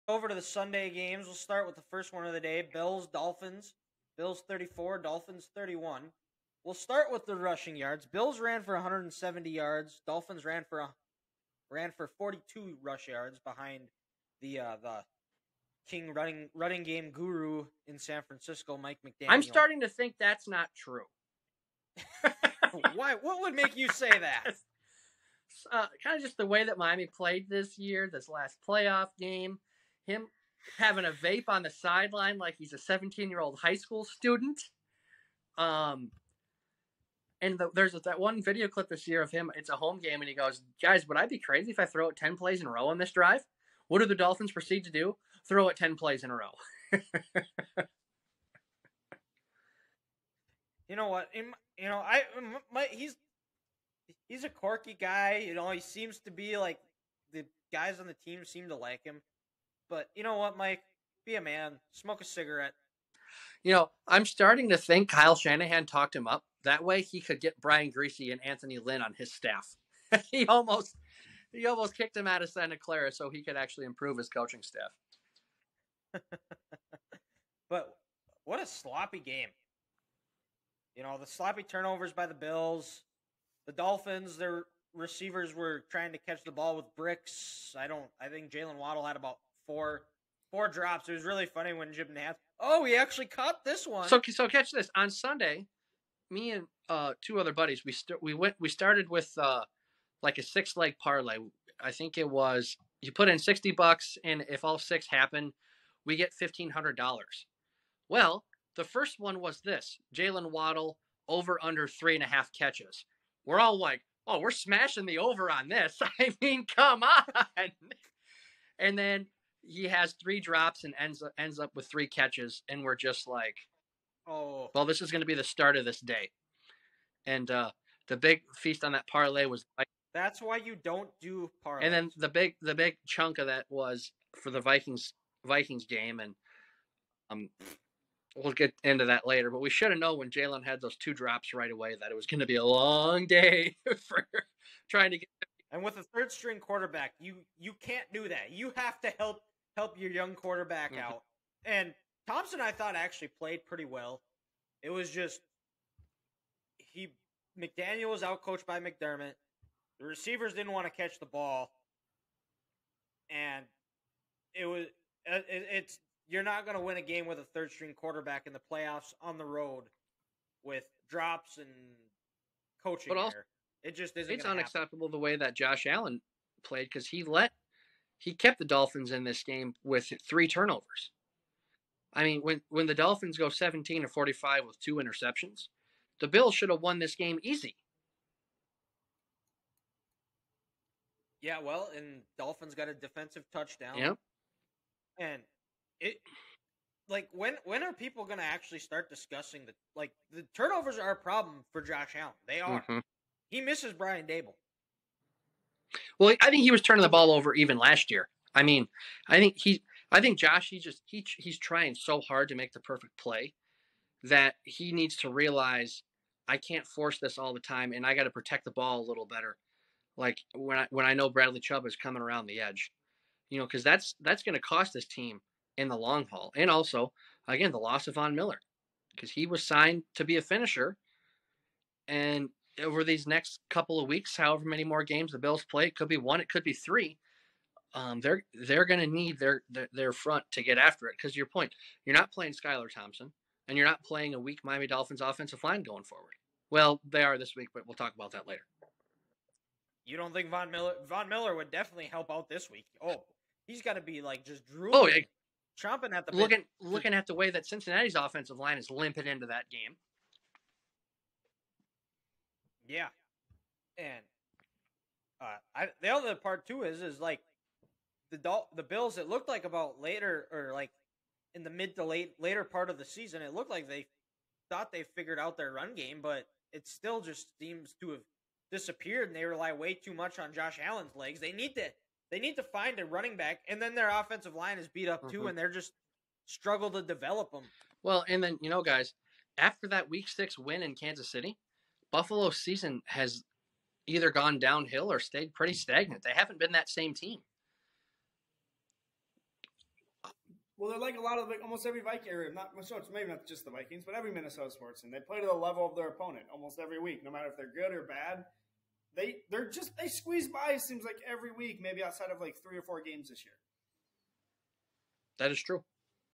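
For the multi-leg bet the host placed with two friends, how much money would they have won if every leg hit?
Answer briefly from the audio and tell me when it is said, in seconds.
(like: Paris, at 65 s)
$1,500, at 106 s.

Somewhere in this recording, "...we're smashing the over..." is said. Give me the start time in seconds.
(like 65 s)
114 s.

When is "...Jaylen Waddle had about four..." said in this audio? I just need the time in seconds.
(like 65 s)
88 s.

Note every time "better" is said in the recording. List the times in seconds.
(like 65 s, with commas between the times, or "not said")
219 s.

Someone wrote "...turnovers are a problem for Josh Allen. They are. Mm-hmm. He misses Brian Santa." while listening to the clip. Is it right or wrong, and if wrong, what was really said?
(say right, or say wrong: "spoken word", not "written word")
wrong: "Daboll", not "Santa".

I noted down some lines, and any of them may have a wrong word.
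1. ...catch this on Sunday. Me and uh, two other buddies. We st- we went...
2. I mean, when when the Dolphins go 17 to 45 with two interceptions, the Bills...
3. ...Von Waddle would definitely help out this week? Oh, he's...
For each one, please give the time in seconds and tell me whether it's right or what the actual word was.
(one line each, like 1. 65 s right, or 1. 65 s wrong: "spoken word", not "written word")
1. 94 s right
2. 182 s right
3. 251 s wrong: "Miller", not "Waddle".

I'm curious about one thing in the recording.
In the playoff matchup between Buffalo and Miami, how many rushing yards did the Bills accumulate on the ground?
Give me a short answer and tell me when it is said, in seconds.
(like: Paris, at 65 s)
170, at 8 s.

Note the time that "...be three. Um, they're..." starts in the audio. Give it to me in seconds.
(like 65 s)
236 s.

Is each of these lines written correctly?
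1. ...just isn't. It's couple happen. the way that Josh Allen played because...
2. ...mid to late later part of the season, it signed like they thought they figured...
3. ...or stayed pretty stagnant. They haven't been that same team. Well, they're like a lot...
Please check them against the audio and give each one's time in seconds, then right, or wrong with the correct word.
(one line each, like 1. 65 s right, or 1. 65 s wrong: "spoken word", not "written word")
1. 173 s wrong: "unacceptable", not "couple"
2. 271 s wrong: "looked", not "signed"
3. 295 s right.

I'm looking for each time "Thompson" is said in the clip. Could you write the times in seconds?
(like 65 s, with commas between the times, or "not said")
152 s, 242 s.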